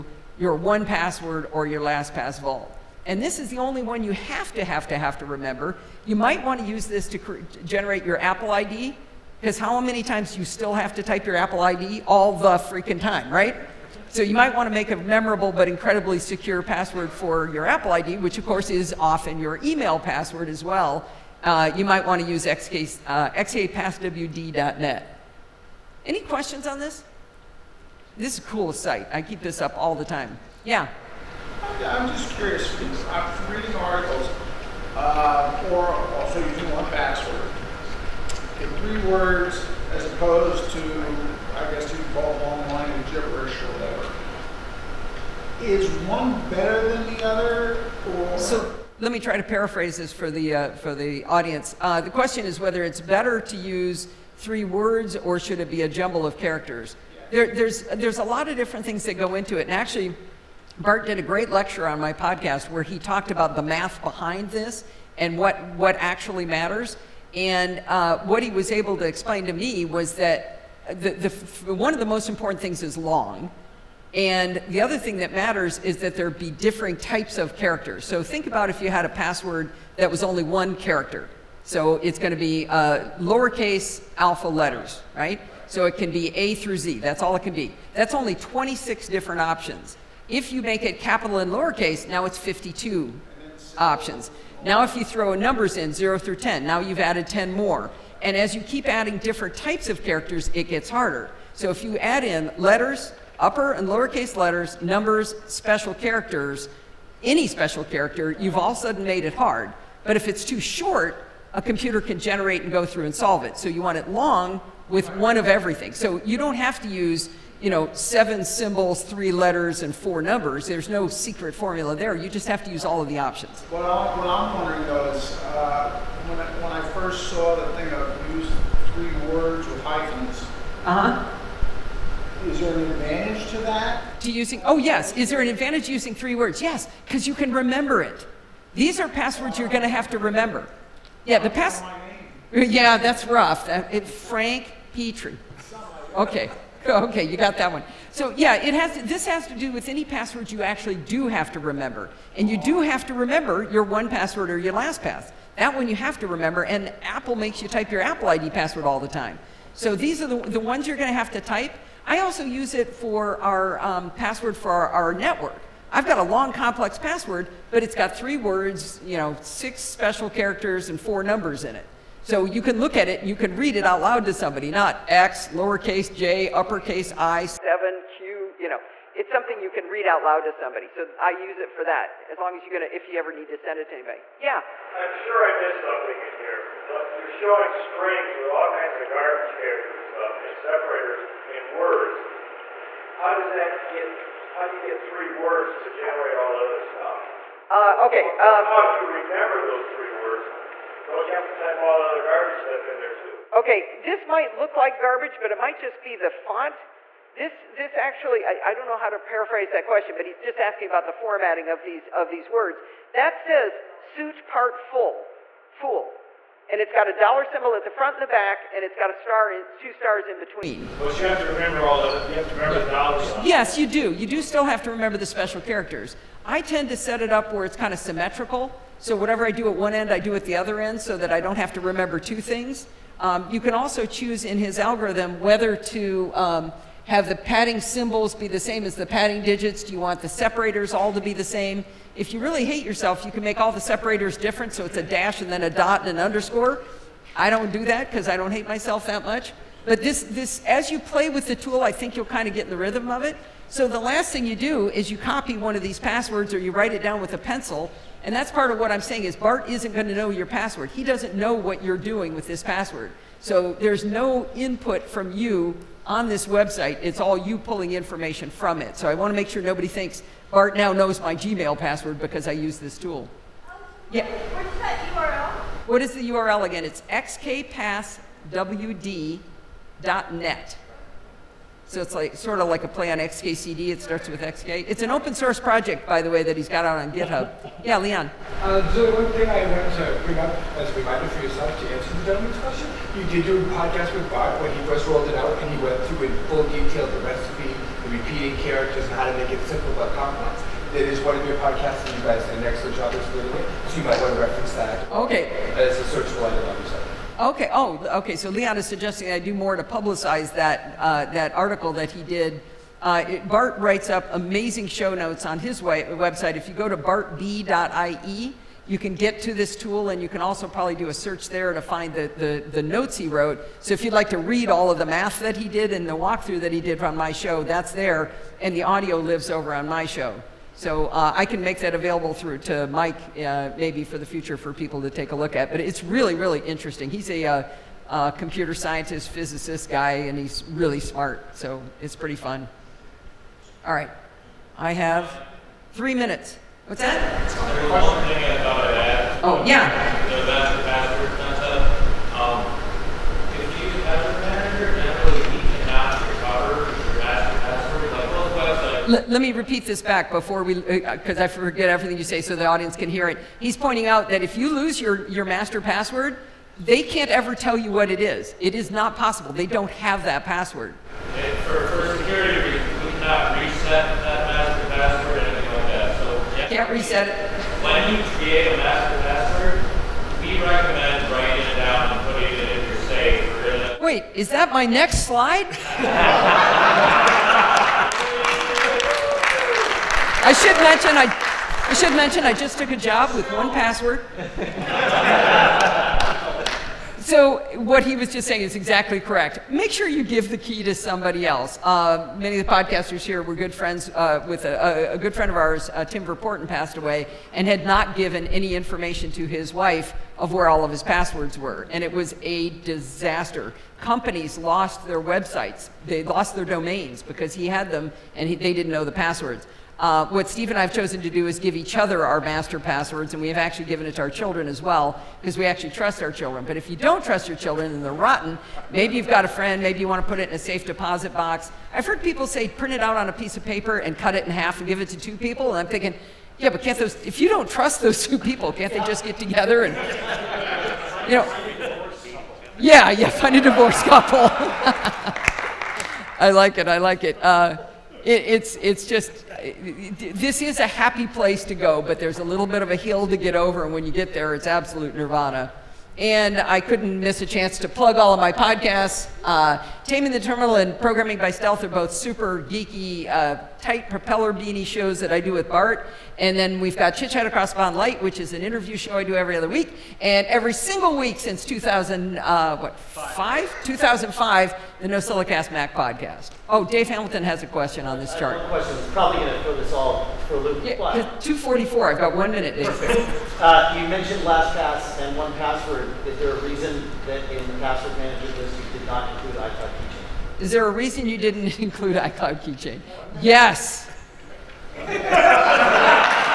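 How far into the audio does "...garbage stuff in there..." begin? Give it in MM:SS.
03:22.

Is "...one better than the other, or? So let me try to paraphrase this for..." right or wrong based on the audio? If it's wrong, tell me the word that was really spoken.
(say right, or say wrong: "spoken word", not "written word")
right.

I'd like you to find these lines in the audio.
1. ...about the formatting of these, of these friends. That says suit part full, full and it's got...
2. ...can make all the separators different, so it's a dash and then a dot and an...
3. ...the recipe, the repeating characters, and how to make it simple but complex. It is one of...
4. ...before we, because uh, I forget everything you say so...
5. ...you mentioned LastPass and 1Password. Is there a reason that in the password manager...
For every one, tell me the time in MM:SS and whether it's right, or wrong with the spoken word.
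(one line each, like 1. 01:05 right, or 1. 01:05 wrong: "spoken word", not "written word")
1. 03:30 wrong: "words", not "friends"
2. 04:03 right
3. 04:57 right
4. 06:00 right
5. 08:03 right.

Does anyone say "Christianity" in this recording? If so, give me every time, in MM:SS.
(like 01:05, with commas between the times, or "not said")
not said.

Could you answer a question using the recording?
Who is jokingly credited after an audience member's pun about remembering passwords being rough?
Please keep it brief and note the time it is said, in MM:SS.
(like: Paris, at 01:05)
Frank Petrie, at 02:24.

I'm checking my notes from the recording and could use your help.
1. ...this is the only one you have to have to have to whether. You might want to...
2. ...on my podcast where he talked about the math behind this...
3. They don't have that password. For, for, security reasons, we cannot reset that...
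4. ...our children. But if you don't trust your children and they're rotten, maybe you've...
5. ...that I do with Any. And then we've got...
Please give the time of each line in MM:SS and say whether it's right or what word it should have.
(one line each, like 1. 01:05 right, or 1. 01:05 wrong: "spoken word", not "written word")
1. 00:03 wrong: "remember", not "whether"
2. 01:01 right
3. 06:09 right
4. 07:06 right
5. 07:45 wrong: "Bart", not "Any".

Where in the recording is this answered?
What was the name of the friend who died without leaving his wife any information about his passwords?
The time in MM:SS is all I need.
06:46.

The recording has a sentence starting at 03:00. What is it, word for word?
So I use it for that, as long as you're going to, if you ever need to send it to anybody.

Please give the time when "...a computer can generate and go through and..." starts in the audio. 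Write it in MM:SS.
01:51.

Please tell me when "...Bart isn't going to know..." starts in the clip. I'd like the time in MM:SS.
04:19.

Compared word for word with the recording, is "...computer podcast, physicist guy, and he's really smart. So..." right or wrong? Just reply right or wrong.
wrong.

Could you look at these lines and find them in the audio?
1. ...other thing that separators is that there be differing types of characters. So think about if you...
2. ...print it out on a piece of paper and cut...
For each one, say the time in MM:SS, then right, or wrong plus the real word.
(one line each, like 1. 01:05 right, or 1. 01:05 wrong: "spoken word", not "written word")
1. 01:14 wrong: "matters", not "separators"
2. 07:12 right.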